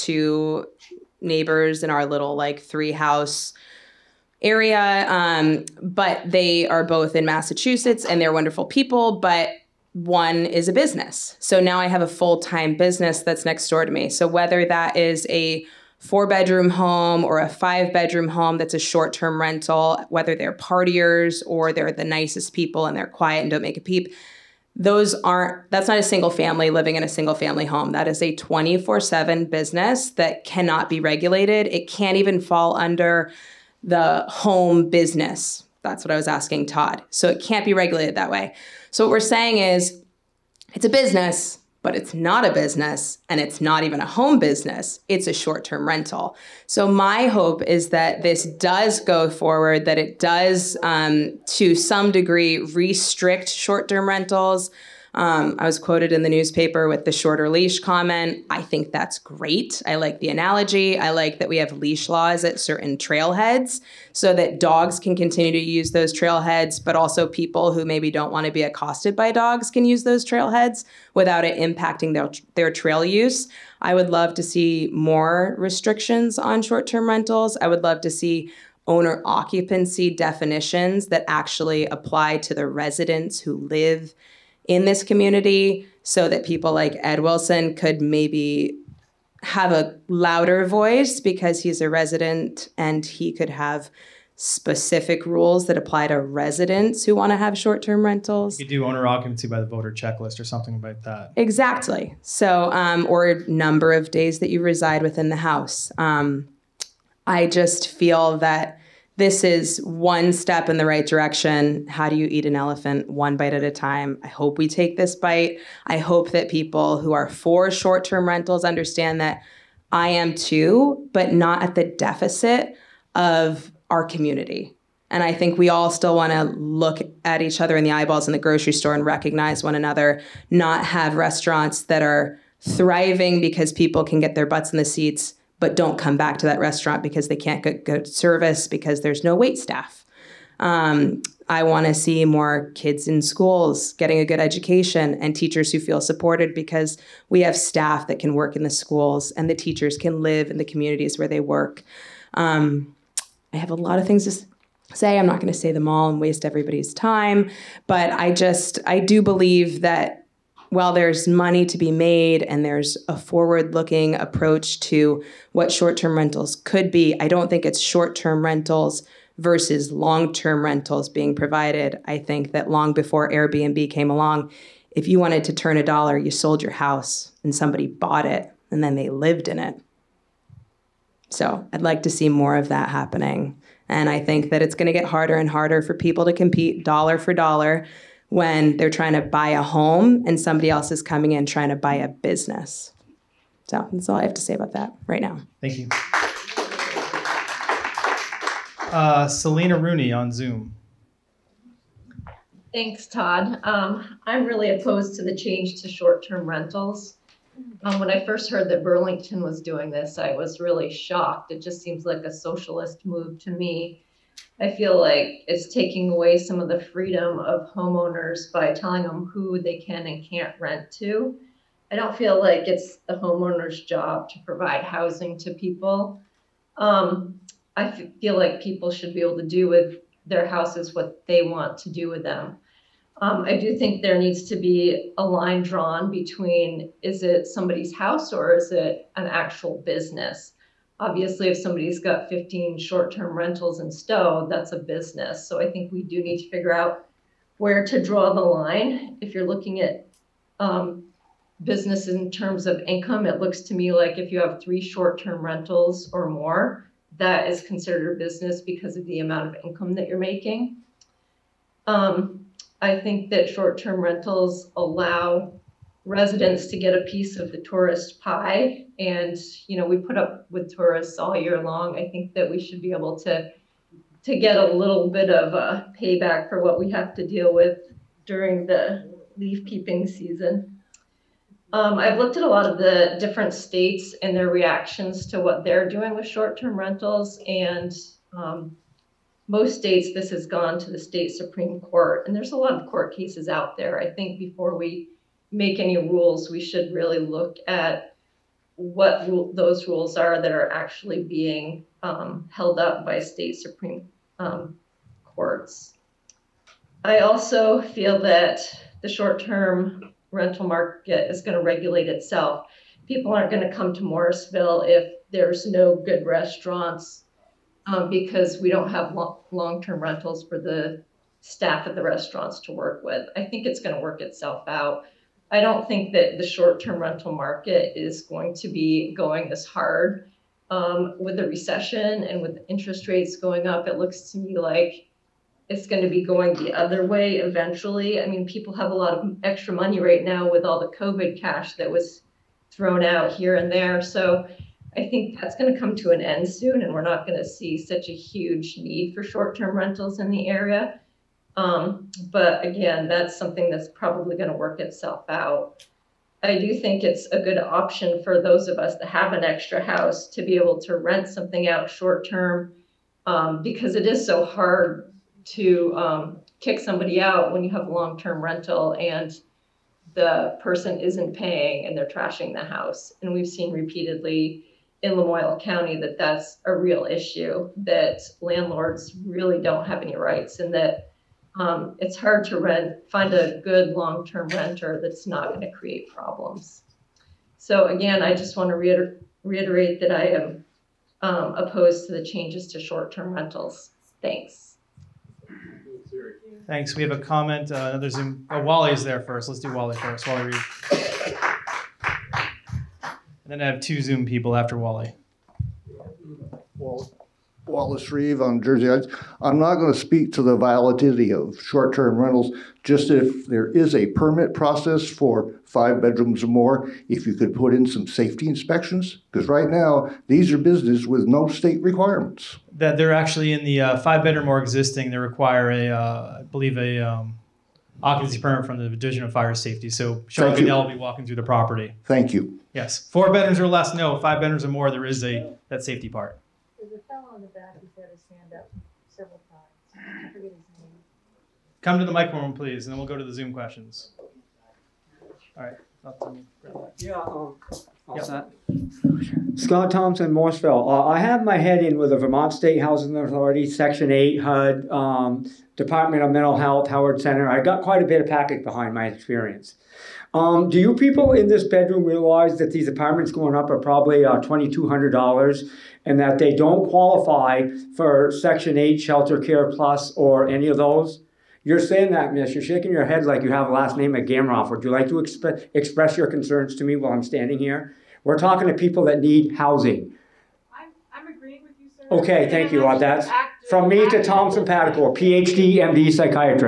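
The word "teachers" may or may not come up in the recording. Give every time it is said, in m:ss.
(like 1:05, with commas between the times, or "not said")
2:25, 2:29.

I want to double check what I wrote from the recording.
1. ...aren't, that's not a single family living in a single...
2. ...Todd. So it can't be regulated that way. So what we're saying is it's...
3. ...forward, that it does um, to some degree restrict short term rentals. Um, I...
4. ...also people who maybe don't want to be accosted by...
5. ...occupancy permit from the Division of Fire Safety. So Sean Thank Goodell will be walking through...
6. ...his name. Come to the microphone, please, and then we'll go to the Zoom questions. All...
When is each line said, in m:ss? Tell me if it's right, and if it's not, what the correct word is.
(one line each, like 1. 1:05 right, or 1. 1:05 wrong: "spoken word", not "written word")
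1. 0:25 right
2. 0:36 right
3. 0:49 right
4. 1:06 right
5. 7:08 right
6. 7:20 right.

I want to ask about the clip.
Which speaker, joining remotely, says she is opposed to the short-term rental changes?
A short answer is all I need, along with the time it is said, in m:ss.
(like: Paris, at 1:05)
Selena Rooney, at 3:19.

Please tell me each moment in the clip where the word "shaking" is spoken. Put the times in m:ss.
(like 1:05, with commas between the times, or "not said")
7:52.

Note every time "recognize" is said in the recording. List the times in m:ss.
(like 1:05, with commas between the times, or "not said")
2:09.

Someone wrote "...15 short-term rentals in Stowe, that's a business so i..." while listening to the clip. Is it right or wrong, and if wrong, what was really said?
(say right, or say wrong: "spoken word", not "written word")
right.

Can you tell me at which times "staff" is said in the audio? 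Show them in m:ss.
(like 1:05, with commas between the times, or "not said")
2:19, 2:27, 5:21.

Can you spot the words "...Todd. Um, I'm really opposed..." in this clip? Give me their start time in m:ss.
3:23.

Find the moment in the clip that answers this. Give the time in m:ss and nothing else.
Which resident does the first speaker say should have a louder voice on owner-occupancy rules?
1:27.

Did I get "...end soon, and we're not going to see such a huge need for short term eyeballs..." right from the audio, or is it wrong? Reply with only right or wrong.
wrong.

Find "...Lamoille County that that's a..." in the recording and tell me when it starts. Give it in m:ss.
6:15.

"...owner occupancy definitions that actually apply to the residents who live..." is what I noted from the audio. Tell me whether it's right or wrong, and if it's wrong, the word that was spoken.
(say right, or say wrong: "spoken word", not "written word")
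right.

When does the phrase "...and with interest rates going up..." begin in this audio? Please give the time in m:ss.
5:32.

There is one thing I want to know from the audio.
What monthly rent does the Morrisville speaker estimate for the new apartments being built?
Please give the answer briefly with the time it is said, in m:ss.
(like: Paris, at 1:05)
$2,200, at 7:44.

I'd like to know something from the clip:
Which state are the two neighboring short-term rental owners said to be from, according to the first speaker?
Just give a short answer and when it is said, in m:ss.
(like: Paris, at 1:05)
Massachusetts, at 0:07.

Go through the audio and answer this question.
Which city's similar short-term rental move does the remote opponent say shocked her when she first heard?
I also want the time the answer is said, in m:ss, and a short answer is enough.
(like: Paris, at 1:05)
Burlington, at 3:28.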